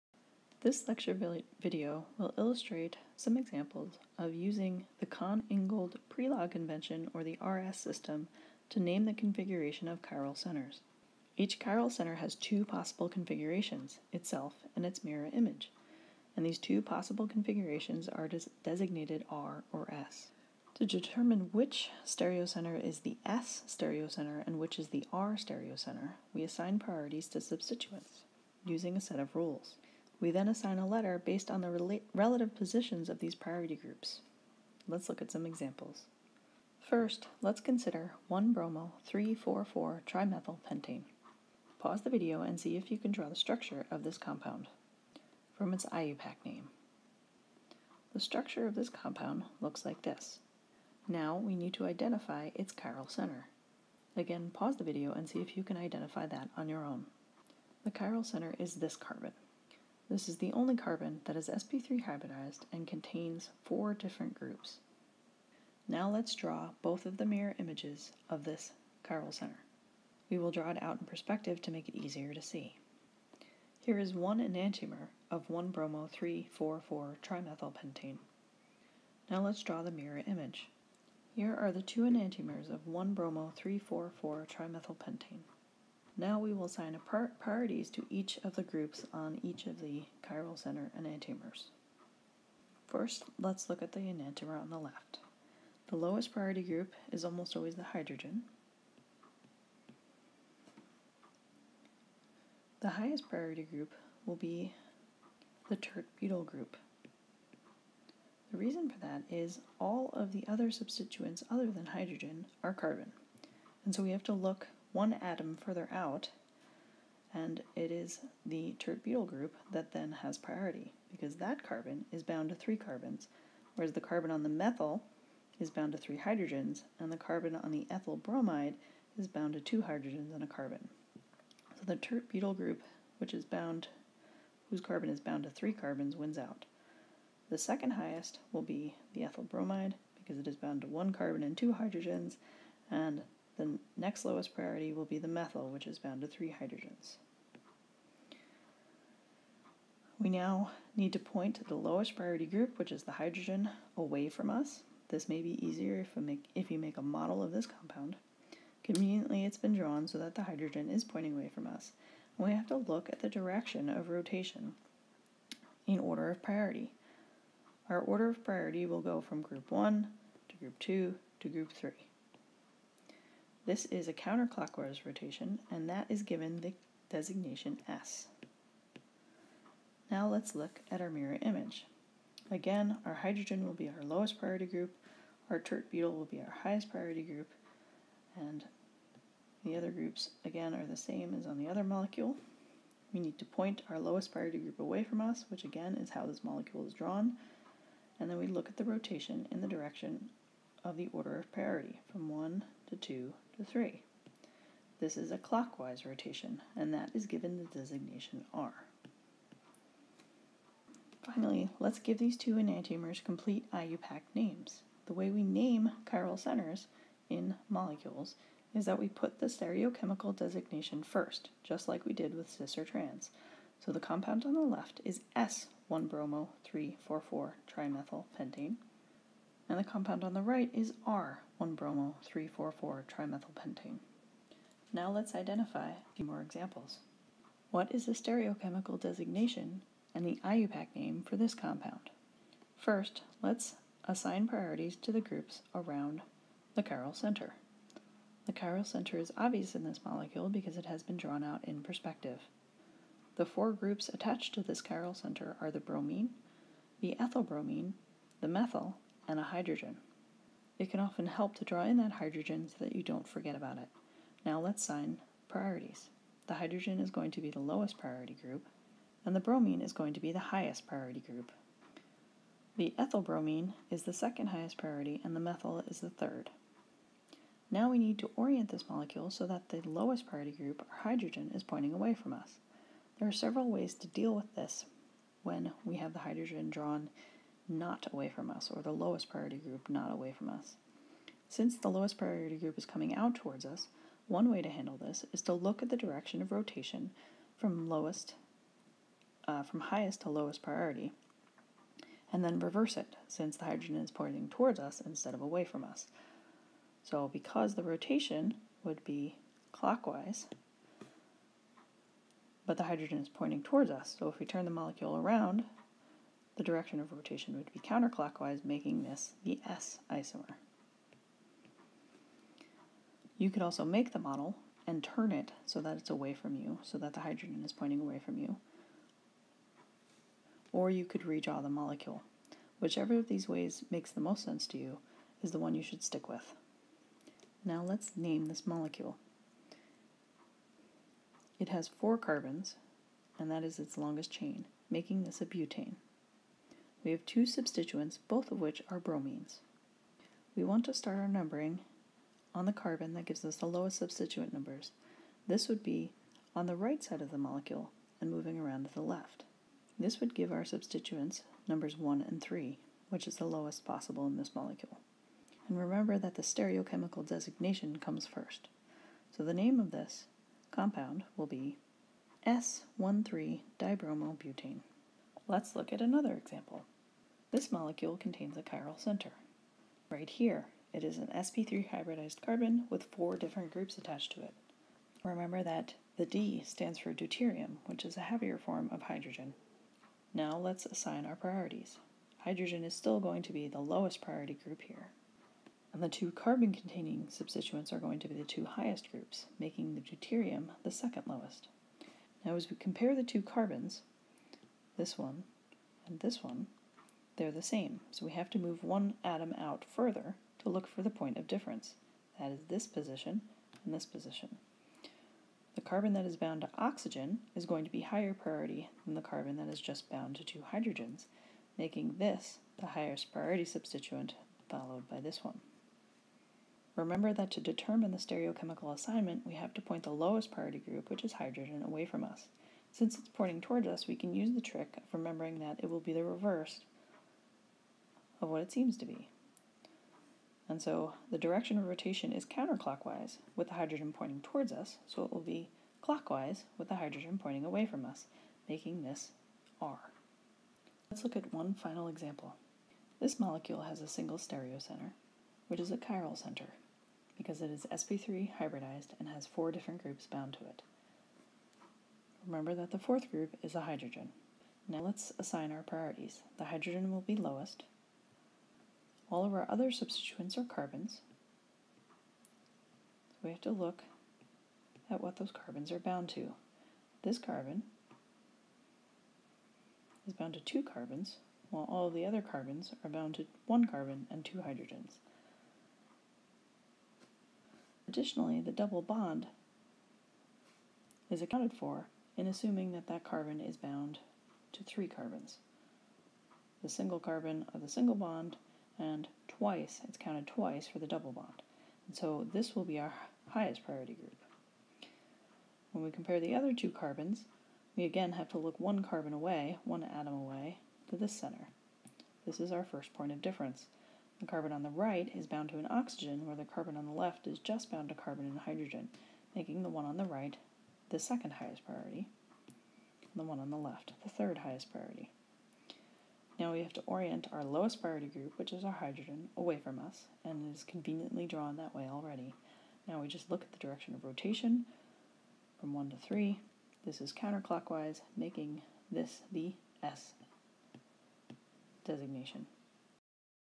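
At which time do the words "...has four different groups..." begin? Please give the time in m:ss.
7:39.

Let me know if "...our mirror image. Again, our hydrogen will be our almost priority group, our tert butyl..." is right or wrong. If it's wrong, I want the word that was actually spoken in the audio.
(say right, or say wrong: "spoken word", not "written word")
wrong: "lowest", not "almost".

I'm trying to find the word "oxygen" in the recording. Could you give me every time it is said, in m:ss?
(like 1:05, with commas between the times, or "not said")
6:56, 8:35.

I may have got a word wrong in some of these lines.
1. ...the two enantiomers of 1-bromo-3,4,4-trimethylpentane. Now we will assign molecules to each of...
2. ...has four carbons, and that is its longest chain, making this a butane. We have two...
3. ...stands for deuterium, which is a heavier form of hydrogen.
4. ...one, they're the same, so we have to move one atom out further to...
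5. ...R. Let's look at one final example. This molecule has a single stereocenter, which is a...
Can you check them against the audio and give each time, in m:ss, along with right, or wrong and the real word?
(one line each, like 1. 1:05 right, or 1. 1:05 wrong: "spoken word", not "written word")
1. 1:21 wrong: "priorities", not "molecules"
2. 5:41 right
3. 6:26 right
4. 6:46 right
5. 7:29 right.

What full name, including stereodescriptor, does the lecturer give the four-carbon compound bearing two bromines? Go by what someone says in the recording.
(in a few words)
S-1,3-dibromobutane.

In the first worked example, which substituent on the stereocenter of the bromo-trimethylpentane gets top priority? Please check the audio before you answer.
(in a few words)
tert-butyl group.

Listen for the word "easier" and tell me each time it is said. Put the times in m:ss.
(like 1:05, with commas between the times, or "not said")
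1:11, 2:35.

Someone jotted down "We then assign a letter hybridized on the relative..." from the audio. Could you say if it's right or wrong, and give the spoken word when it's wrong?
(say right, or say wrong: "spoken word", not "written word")
wrong: "based", not "hybridized".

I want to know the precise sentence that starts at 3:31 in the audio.
Finally, let's give these two enantiomers complete IUPAC names.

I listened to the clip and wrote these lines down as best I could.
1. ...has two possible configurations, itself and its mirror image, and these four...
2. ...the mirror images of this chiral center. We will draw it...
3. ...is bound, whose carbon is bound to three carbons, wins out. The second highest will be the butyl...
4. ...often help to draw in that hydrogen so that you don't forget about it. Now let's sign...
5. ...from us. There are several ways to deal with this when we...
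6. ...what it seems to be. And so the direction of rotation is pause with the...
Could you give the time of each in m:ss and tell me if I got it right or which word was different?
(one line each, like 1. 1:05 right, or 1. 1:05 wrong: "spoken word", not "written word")
1. 0:12 wrong: "two", not "four"
2. 1:07 right
3. 2:13 wrong: "ethyl", not "butyl"
4. 4:20 right
5. 4:42 right
6. 7:18 wrong: "counterclockwise", not "pause".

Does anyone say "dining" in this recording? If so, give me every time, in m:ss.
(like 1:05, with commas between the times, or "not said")
not said.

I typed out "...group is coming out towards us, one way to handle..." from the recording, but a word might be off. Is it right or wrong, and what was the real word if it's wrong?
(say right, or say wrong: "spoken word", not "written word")
right.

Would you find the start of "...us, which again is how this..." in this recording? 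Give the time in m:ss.
3:15.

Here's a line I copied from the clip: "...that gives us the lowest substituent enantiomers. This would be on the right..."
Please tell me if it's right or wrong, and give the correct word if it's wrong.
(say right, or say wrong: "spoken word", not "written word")
wrong: "numbers", not "enantiomers".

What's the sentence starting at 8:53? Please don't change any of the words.
Now we just look at the direction of rotation from 1 to 3.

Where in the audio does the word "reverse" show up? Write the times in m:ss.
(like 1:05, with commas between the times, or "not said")
5:02, 7:16.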